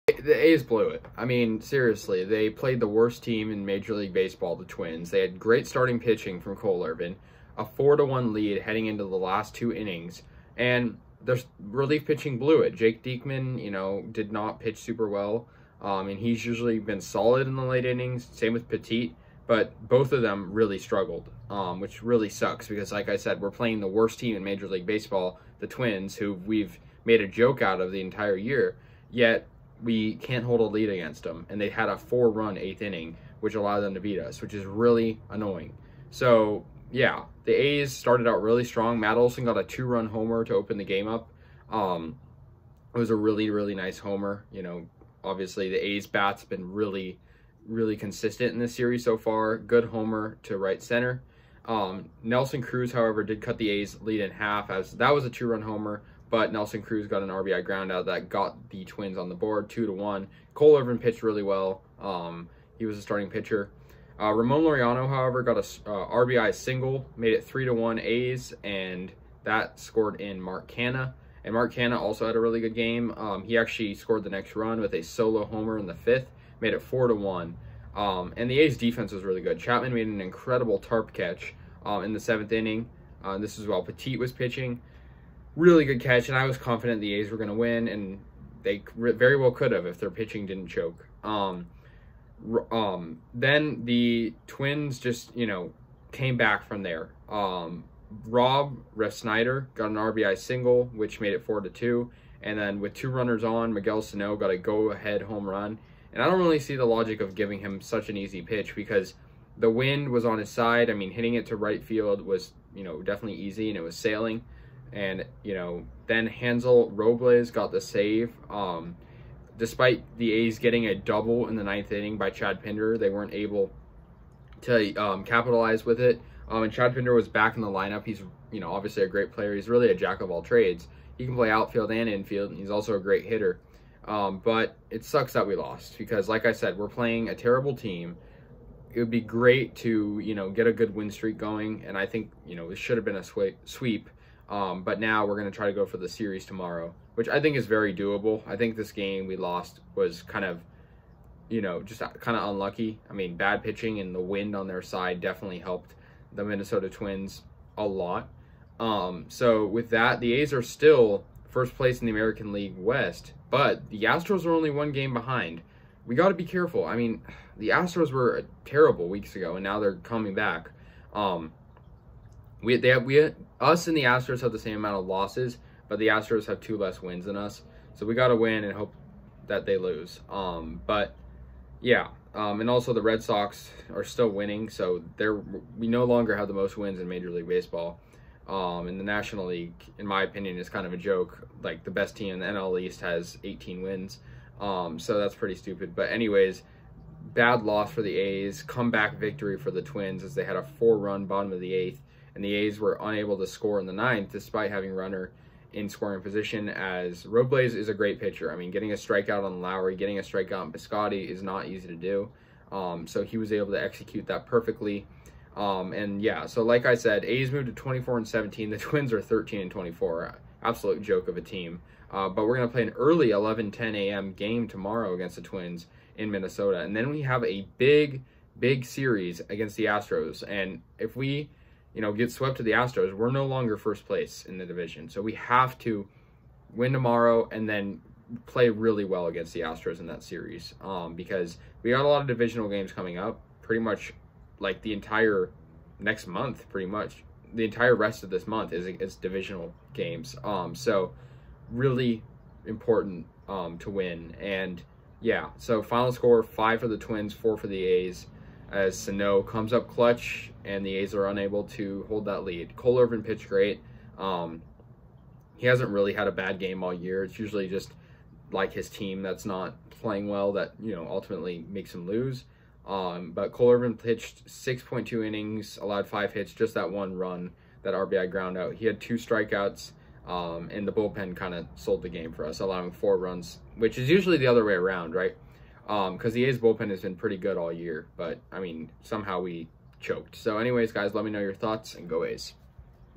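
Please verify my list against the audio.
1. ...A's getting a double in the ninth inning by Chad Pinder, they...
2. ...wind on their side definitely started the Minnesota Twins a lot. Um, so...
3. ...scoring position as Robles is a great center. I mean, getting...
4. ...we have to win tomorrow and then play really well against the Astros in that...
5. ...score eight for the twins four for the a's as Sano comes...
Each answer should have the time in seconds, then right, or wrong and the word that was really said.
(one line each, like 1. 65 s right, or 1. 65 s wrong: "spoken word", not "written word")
1. 120 s right
2. 154 s wrong: "helped", not "started"
3. 205 s wrong: "pitcher", not "center"
4. 235 s right
5. 256 s wrong: "five", not "eight".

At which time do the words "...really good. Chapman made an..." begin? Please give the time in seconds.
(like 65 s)
79 s.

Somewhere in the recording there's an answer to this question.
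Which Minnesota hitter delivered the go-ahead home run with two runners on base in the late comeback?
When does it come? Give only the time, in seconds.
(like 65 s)
103 s.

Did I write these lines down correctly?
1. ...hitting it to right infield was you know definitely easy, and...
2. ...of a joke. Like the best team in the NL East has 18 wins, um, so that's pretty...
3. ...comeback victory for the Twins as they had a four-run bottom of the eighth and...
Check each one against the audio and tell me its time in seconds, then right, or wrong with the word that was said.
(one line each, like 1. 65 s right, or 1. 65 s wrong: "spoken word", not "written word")
1. 111 s wrong: "field", not "infield"
2. 190 s right
3. 198 s right.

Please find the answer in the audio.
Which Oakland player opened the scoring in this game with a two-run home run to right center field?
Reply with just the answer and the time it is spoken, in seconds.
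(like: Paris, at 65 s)
Matt Olson, at 38 s.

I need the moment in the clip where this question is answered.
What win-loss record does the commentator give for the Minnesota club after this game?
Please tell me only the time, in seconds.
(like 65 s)
219 s.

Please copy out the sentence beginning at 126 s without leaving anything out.
Um, and Chad Pinder was back in the lineup.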